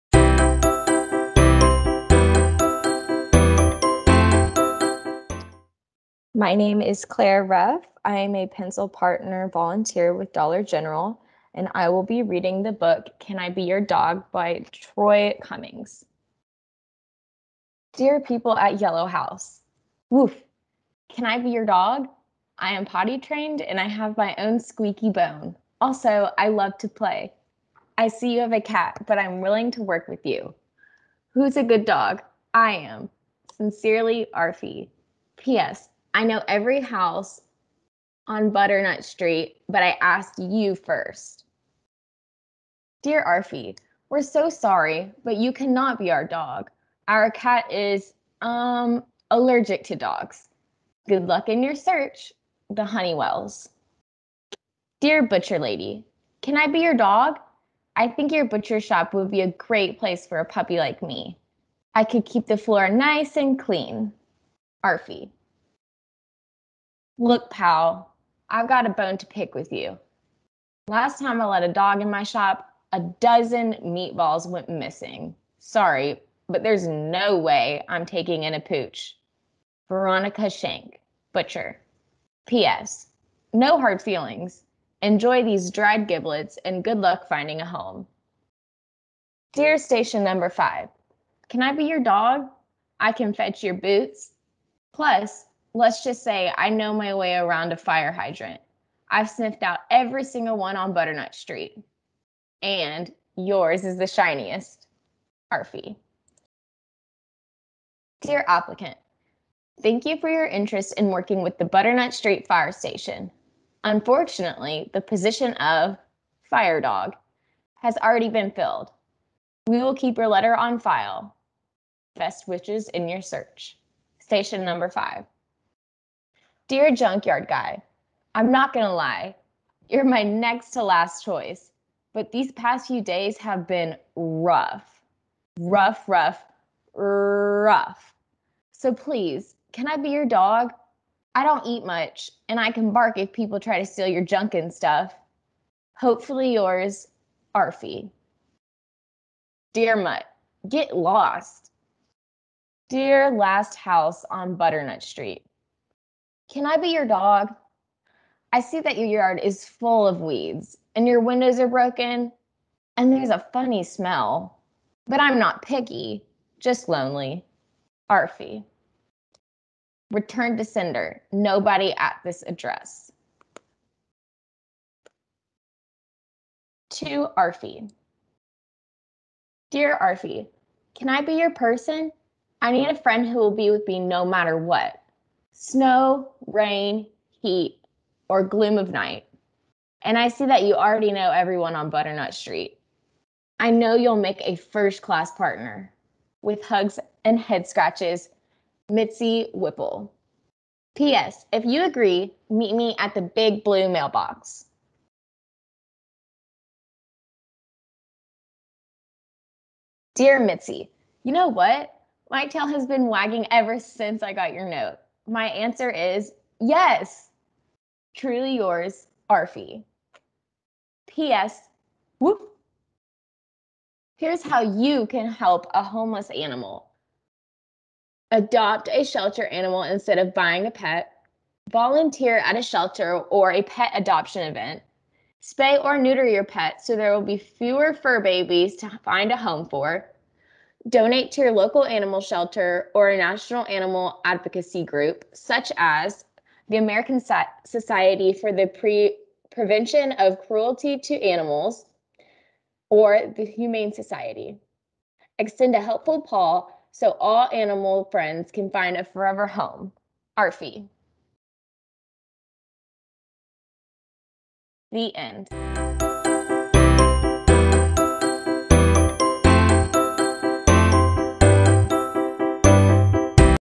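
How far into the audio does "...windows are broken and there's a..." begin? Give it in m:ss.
2:41.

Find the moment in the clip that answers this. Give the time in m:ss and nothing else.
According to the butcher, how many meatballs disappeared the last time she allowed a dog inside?
1:12.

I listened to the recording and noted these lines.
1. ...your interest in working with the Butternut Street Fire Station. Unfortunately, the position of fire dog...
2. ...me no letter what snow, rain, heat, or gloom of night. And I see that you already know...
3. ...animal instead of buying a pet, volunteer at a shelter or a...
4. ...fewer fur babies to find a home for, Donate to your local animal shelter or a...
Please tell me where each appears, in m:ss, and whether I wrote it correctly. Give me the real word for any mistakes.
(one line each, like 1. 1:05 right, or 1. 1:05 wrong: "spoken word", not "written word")
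1. 1:50 right
2. 3:03 wrong: "matter", not "letter"
3. 3:49 right
4. 3:57 right.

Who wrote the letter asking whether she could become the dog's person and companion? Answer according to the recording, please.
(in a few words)
Mitzi Whipple.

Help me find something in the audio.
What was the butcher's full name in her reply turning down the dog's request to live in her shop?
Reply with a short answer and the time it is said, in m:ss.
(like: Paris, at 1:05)
Veronica Shank, at 1:19.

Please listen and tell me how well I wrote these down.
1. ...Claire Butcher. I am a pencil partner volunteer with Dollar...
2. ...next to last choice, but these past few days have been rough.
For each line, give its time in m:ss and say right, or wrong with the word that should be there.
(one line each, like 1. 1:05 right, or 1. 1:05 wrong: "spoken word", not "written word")
1. 0:07 wrong: "Reff", not "Butcher"
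2. 2:10 right.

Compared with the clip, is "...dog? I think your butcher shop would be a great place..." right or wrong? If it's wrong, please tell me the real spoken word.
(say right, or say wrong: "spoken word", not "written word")
right.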